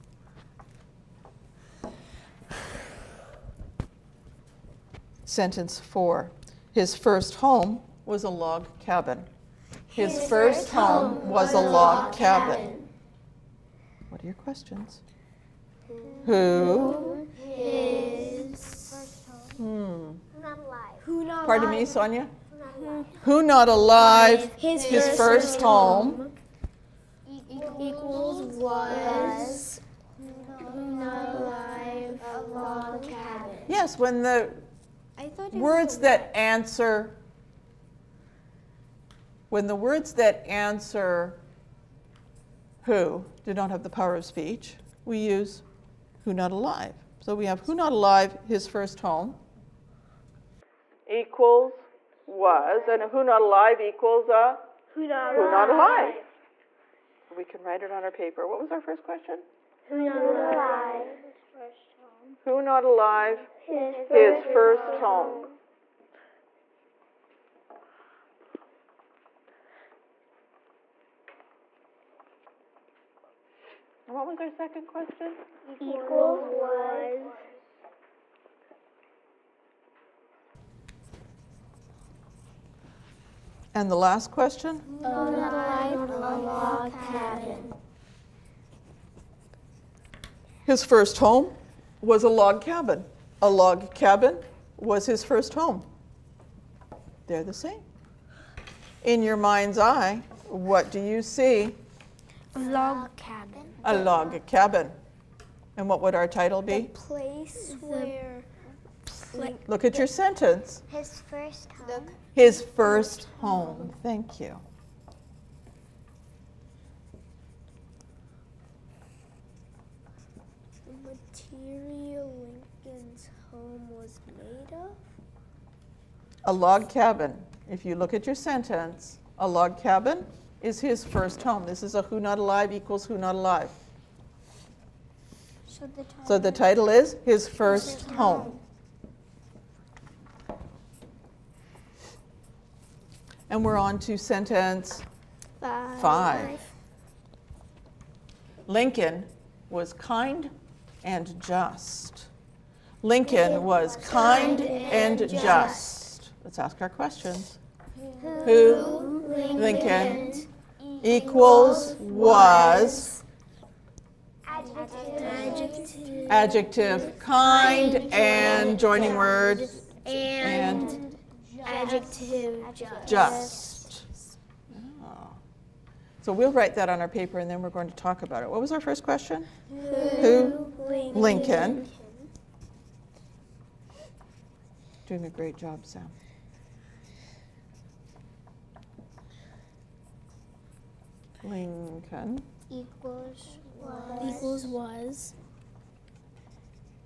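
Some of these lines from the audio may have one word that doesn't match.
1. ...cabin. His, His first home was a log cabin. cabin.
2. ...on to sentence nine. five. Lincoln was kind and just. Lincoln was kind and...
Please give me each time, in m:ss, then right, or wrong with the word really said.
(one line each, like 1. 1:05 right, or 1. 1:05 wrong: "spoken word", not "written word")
1. 0:08 right
2. 2:23 wrong: "five", not "nine".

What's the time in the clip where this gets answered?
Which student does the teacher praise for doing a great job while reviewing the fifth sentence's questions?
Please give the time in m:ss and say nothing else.
3:05.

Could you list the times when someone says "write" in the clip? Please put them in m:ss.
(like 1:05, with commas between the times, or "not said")
0:57, 2:56.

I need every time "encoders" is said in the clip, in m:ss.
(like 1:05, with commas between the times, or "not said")
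not said.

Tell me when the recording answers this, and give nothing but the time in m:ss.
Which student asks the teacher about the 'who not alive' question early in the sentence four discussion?
0:21.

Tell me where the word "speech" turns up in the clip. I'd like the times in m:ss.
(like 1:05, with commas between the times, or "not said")
0:44.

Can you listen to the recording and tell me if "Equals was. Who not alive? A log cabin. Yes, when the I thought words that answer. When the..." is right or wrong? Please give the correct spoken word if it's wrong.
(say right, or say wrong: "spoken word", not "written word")
right.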